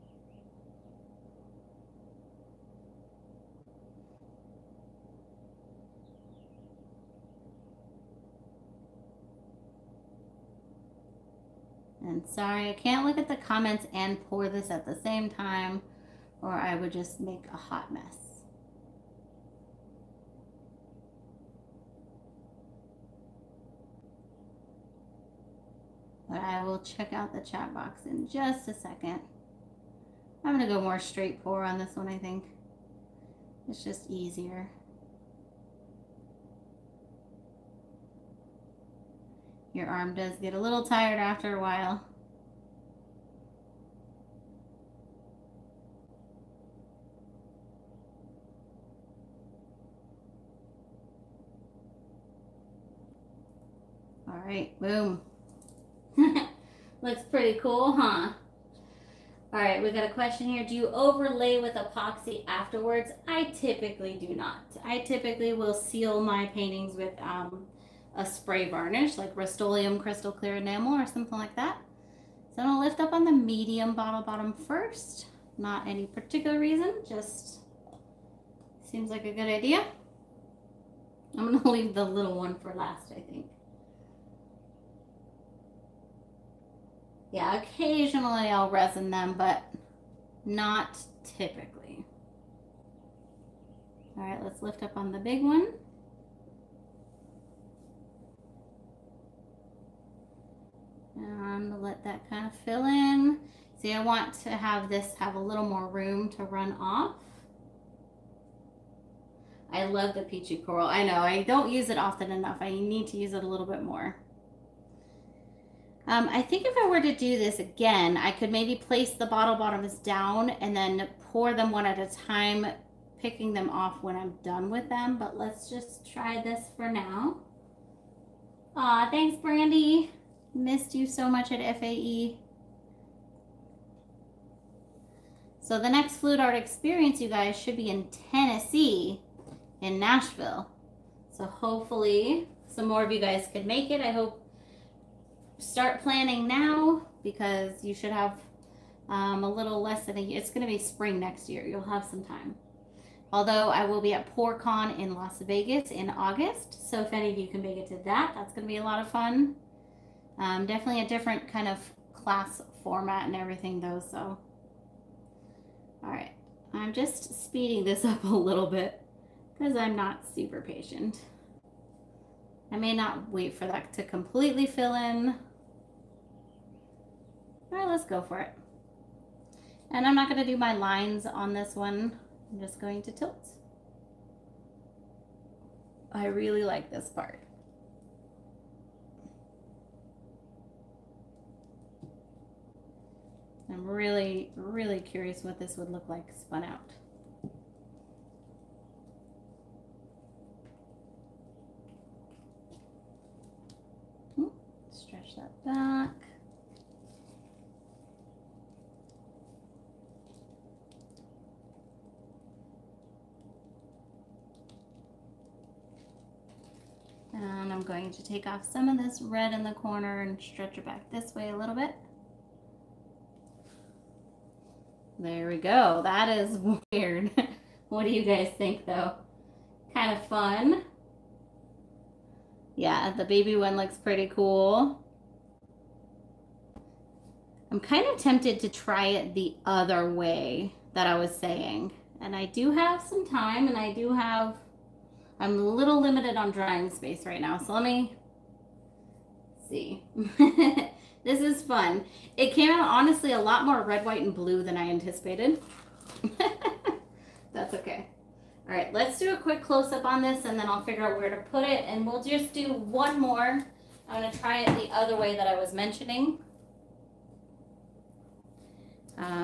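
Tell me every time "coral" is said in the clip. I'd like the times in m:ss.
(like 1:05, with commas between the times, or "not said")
1:50.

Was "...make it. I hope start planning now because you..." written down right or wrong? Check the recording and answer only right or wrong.
right.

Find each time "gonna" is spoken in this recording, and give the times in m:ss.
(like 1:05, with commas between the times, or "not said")
1:12, 1:21.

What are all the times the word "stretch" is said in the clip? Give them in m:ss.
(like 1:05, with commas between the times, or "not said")
3:24, 3:40.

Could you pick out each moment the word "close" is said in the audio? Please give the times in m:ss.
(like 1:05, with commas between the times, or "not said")
4:19.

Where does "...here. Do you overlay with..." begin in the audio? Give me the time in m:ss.
1:00.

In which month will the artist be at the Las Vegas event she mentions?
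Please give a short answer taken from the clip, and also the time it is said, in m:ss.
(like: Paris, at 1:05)
August, at 2:36.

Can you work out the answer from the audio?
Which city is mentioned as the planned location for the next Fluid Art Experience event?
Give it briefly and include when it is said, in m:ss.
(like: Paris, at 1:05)
Nashville, at 2:19.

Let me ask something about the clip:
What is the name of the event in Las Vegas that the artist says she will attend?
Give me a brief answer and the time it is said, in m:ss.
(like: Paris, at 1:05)
PourCon, at 2:34.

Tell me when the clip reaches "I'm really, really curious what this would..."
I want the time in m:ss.
3:13.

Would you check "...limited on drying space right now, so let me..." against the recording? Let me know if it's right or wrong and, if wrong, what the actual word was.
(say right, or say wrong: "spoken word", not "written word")
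right.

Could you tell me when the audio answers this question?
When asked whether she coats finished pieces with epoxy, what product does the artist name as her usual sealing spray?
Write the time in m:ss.
1:09.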